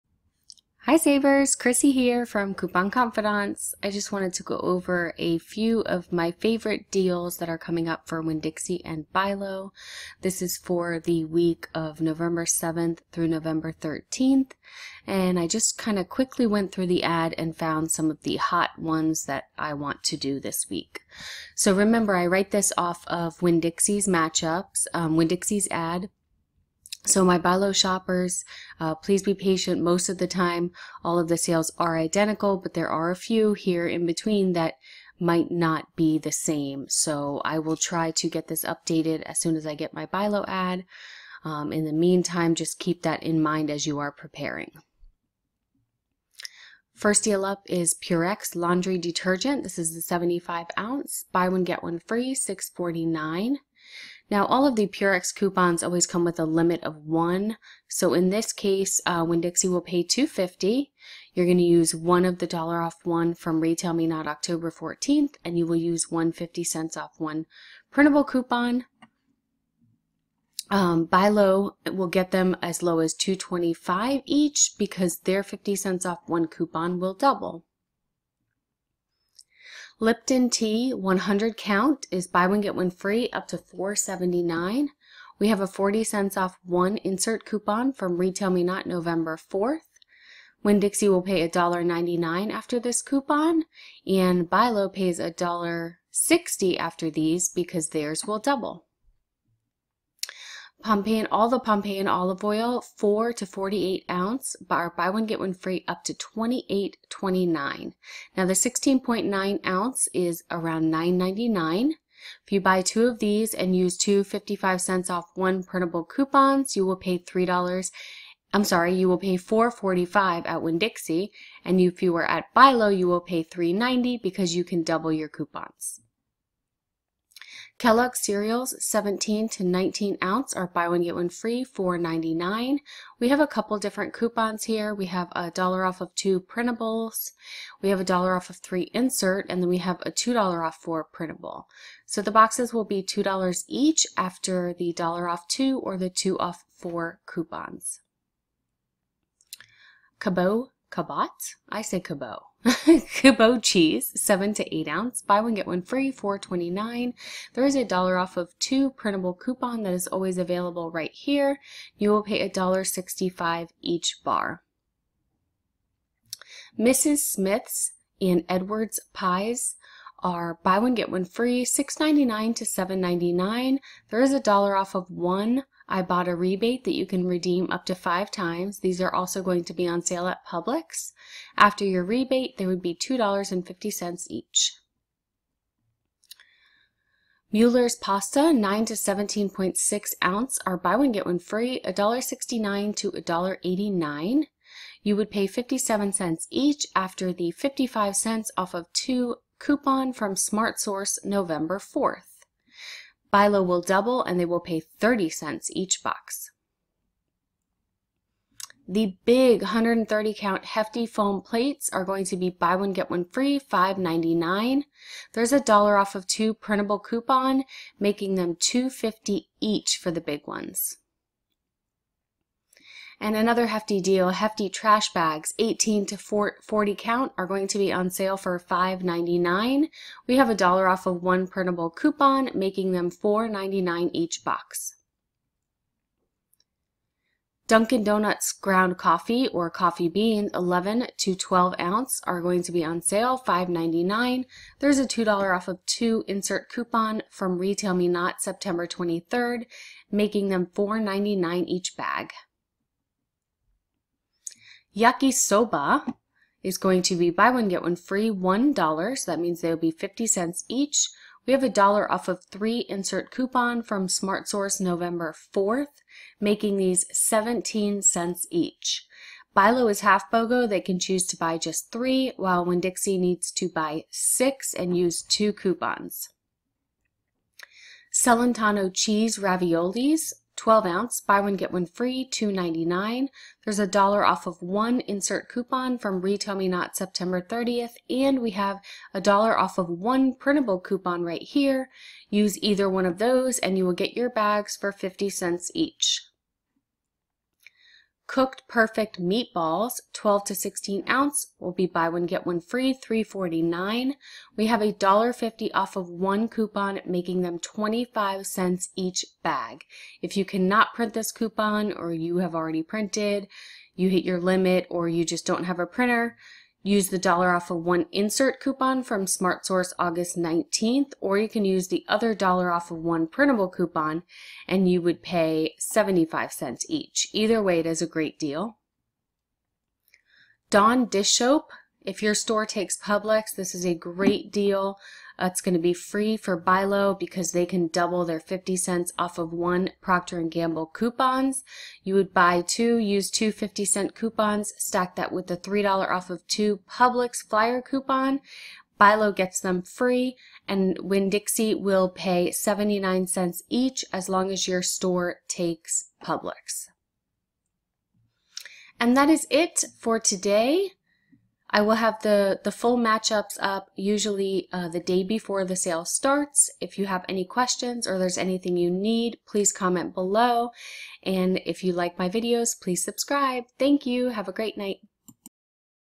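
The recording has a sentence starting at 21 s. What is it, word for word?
So remember, I write this off of Winn-Dixie's matchups, um, Winn-Dixie's ad.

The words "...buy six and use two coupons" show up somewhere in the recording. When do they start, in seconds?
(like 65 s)
273 s.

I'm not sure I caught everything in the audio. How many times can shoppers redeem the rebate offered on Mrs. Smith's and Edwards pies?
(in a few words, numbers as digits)
5.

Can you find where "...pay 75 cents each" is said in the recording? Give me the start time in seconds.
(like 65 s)
325 s.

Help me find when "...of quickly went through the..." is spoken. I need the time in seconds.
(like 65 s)
15 s.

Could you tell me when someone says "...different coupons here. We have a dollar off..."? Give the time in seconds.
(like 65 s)
133 s.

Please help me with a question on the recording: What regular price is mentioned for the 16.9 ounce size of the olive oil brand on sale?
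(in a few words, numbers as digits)
$9.99.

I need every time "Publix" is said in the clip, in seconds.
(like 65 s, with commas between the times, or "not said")
180 s, 332 s, 346 s, 356 s.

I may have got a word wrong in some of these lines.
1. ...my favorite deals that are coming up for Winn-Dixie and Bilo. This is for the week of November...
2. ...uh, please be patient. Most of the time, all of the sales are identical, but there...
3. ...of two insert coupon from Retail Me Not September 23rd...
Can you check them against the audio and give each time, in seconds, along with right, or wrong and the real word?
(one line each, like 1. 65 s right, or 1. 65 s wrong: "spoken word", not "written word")
1. 6 s right
2. 28 s right
3. 245 s right.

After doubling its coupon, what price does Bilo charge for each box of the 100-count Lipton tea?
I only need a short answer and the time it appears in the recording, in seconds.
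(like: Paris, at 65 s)
$1.60, at 95 s.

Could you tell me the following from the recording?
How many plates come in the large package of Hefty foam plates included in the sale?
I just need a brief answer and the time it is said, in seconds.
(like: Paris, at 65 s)
130, at 209 s.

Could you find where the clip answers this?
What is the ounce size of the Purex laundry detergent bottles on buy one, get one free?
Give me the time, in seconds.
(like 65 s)
50 s.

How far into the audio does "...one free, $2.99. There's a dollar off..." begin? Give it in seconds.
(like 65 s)
281 s.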